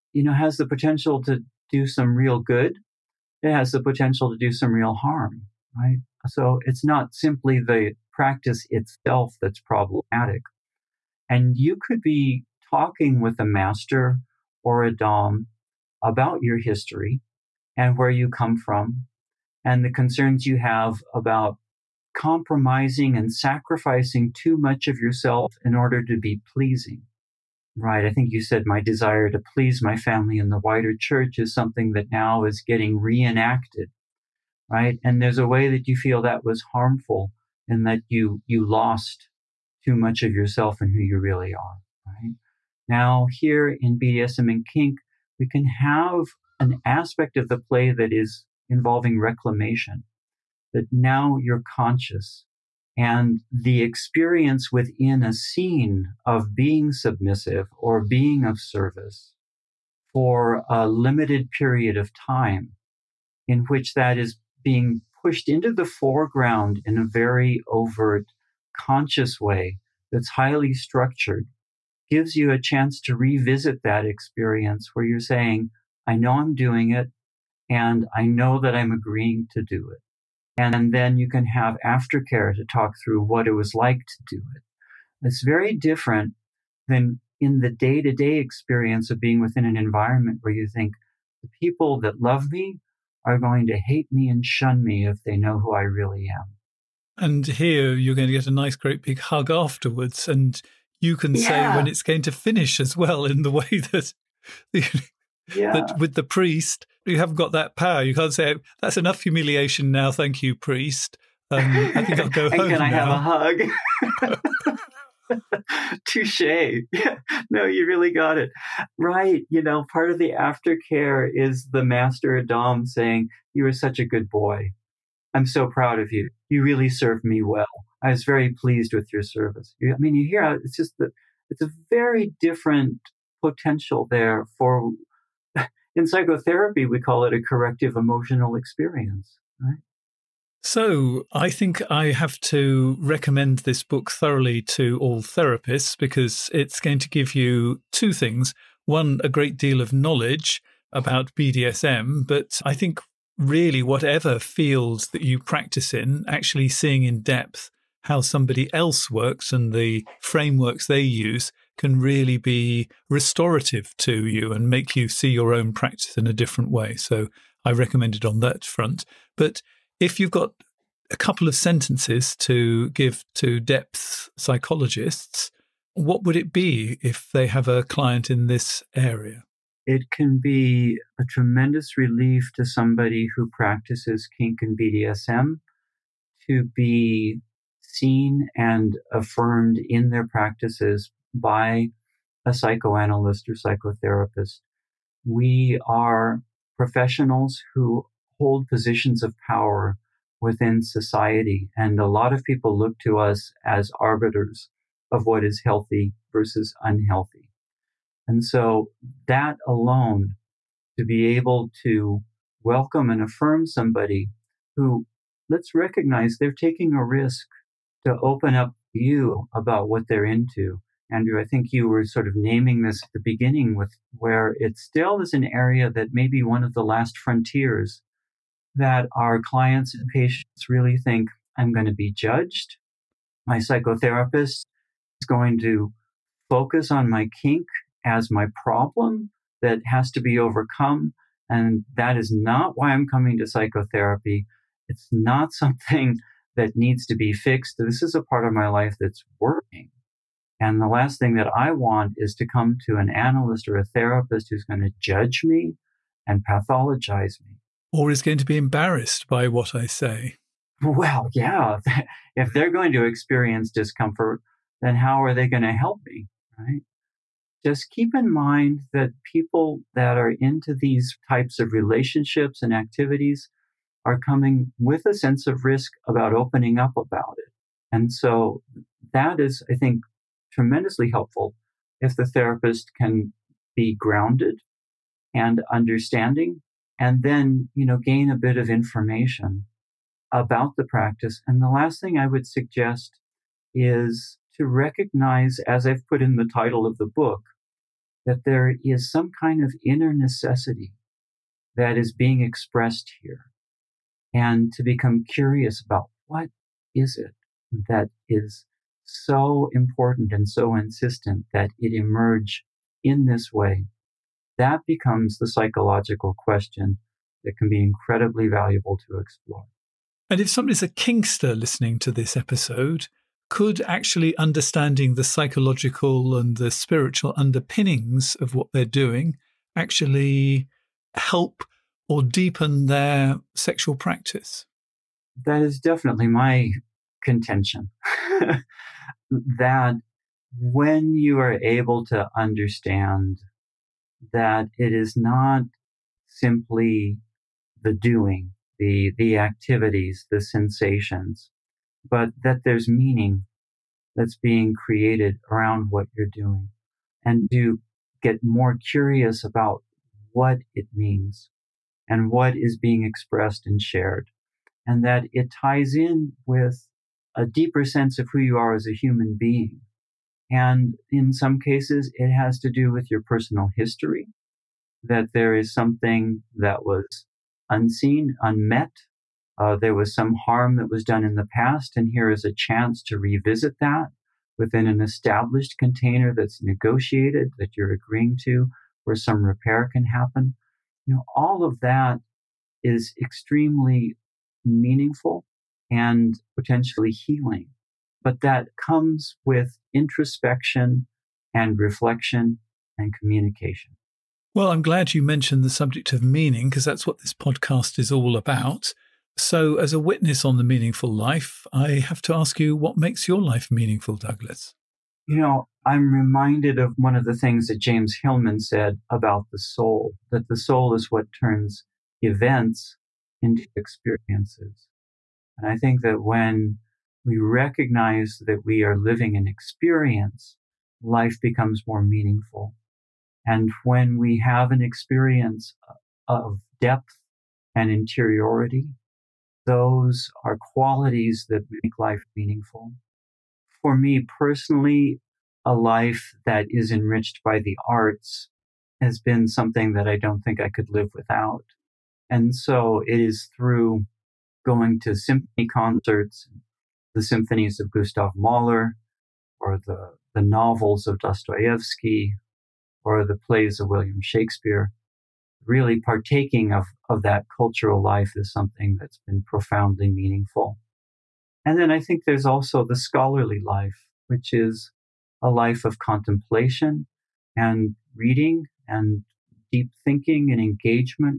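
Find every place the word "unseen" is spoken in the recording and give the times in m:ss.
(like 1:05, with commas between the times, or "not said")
6:17.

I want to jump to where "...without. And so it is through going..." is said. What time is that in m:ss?
7:31.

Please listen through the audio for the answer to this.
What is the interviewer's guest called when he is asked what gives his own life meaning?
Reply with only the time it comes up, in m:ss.
6:54.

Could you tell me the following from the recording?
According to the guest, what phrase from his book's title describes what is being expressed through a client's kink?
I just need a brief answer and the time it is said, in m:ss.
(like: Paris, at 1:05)
Inner necessity, at 4:59.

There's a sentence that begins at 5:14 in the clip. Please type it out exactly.
That becomes the psychological question that can be incredibly valuable to explore.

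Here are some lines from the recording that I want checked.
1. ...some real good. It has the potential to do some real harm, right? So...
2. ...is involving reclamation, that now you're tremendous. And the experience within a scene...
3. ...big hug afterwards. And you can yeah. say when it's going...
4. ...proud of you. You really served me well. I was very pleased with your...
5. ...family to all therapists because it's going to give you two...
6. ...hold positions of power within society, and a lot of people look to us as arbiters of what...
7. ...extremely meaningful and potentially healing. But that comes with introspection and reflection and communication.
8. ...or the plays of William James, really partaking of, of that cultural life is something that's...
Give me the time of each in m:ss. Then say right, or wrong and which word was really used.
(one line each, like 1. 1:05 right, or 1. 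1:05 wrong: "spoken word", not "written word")
1. 0:01 right
2. 0:48 wrong: "conscious", not "tremendous"
3. 1:39 right
4. 2:05 right
5. 2:24 wrong: "thoroughly", not "family"
6. 3:18 right
7. 6:33 right
8. 7:43 wrong: "Shakespeare", not "James".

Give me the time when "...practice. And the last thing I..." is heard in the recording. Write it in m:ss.
4:50.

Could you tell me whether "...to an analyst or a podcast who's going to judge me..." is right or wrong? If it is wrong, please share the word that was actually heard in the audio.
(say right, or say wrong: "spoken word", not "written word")
wrong: "therapist", not "podcast".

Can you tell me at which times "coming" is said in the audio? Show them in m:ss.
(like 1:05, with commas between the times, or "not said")
4:03, 4:34.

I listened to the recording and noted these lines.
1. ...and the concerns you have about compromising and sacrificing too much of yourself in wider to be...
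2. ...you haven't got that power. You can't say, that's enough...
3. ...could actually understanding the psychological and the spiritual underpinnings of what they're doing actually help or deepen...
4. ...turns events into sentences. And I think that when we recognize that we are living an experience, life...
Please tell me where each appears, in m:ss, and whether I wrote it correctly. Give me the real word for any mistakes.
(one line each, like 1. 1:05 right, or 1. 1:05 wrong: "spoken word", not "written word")
1. 0:19 wrong: "order", not "wider"
2. 1:47 right
3. 5:23 right
4. 7:01 wrong: "experiences", not "sentences".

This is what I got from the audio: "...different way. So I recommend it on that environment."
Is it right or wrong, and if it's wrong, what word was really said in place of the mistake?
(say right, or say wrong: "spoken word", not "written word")
wrong: "front", not "environment".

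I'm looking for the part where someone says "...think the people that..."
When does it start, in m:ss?
1:30.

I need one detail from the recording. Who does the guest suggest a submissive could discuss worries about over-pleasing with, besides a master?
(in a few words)
A Dom.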